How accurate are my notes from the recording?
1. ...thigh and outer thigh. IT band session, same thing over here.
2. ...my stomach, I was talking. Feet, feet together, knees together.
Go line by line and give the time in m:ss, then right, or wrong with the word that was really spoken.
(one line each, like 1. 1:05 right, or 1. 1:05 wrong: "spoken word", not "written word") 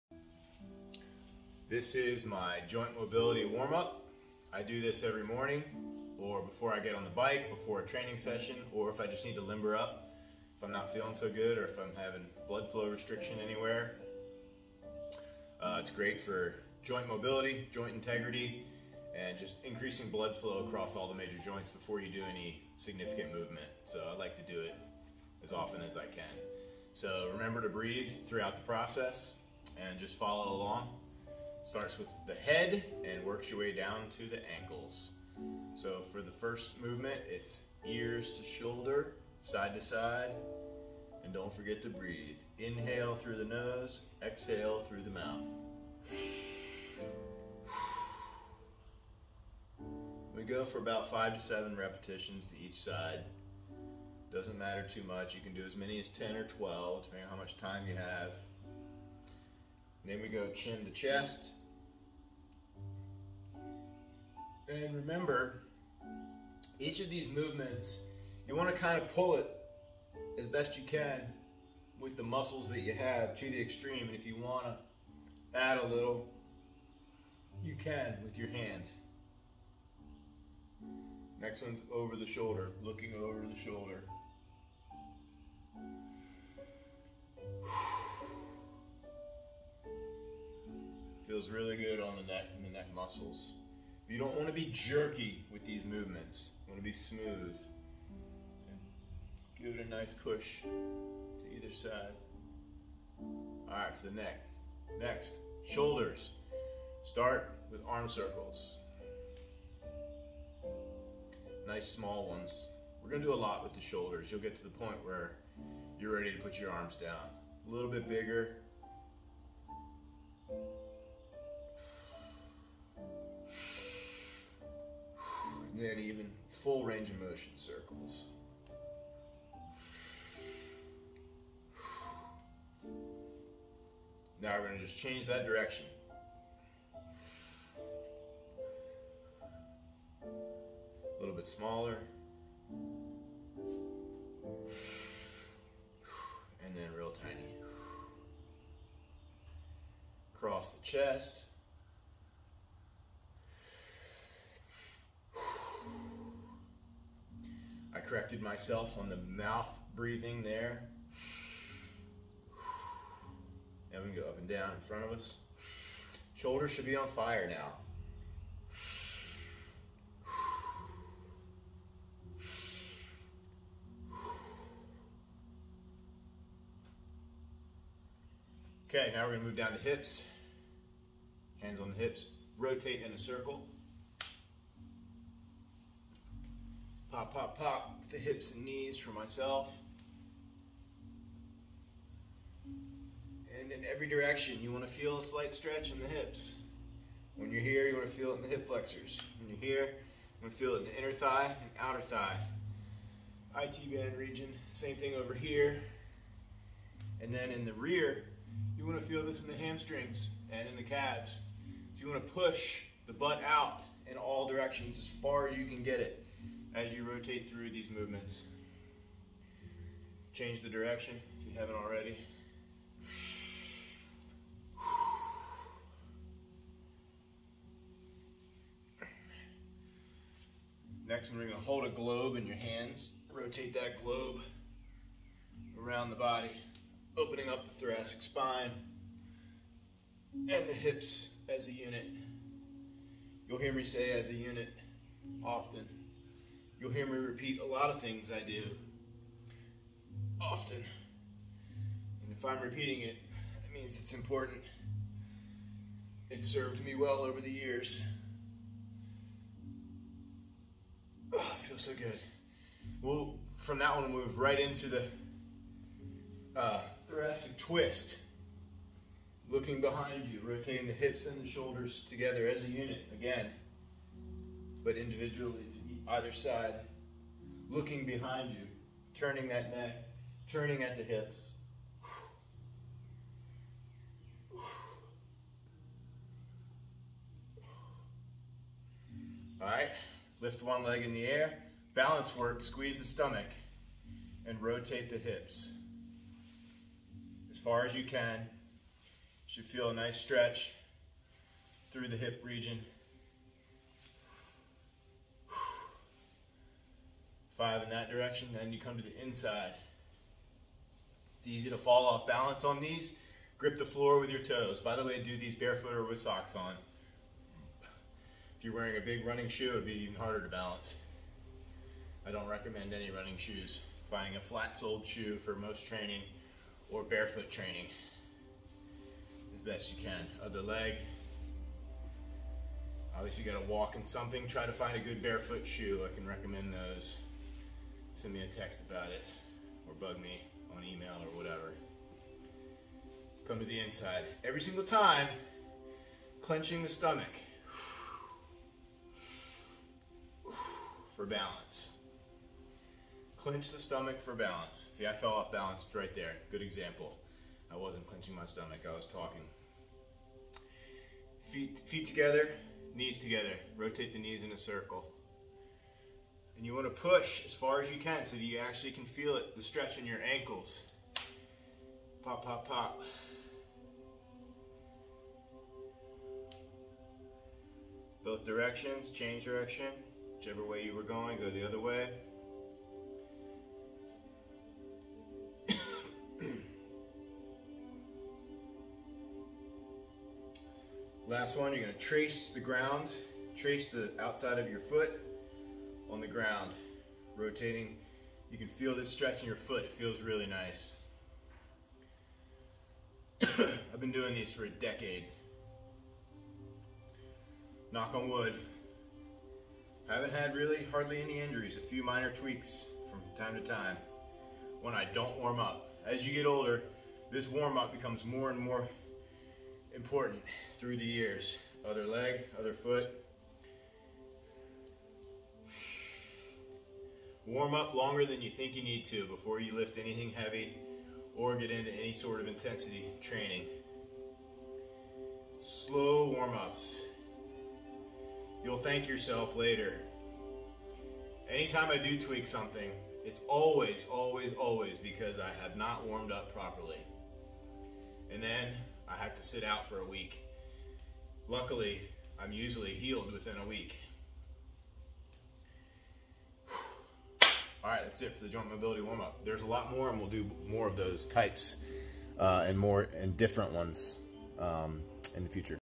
1. 3:21 wrong: "region", not "session"
2. 5:58 right.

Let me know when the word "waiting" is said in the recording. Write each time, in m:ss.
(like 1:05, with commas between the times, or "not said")
not said.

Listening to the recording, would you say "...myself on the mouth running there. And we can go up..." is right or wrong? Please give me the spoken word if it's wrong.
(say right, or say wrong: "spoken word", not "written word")
wrong: "breathing", not "running".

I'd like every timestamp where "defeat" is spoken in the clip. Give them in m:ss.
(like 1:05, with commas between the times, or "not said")
not said.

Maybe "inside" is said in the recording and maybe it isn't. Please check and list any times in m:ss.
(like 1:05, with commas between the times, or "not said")
5:09, 5:43.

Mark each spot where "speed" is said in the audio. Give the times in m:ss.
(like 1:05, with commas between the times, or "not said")
not said.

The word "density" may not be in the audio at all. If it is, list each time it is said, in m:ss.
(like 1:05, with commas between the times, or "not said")
not said.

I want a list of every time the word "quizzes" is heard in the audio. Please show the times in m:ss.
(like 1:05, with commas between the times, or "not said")
not said.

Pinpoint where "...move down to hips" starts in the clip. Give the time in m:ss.
2:59.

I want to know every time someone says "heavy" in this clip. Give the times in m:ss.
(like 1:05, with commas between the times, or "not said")
7:10.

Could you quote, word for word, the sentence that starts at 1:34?
You don't want to be jerky with these movements.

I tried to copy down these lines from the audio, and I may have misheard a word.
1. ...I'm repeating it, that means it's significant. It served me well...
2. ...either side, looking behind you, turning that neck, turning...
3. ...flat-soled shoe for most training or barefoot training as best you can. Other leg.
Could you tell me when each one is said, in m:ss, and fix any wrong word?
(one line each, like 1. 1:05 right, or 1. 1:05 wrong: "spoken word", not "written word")
1. 4:12 wrong: "important", not "significant"
2. 4:36 right
3. 5:24 right.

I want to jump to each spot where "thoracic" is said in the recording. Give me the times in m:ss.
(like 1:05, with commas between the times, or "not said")
3:57, 4:27.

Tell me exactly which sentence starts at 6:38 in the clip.
You can feel this stretch in your foot.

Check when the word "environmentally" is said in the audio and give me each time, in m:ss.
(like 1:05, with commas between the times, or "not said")
not said.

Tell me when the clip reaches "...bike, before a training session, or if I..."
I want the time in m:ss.
0:07.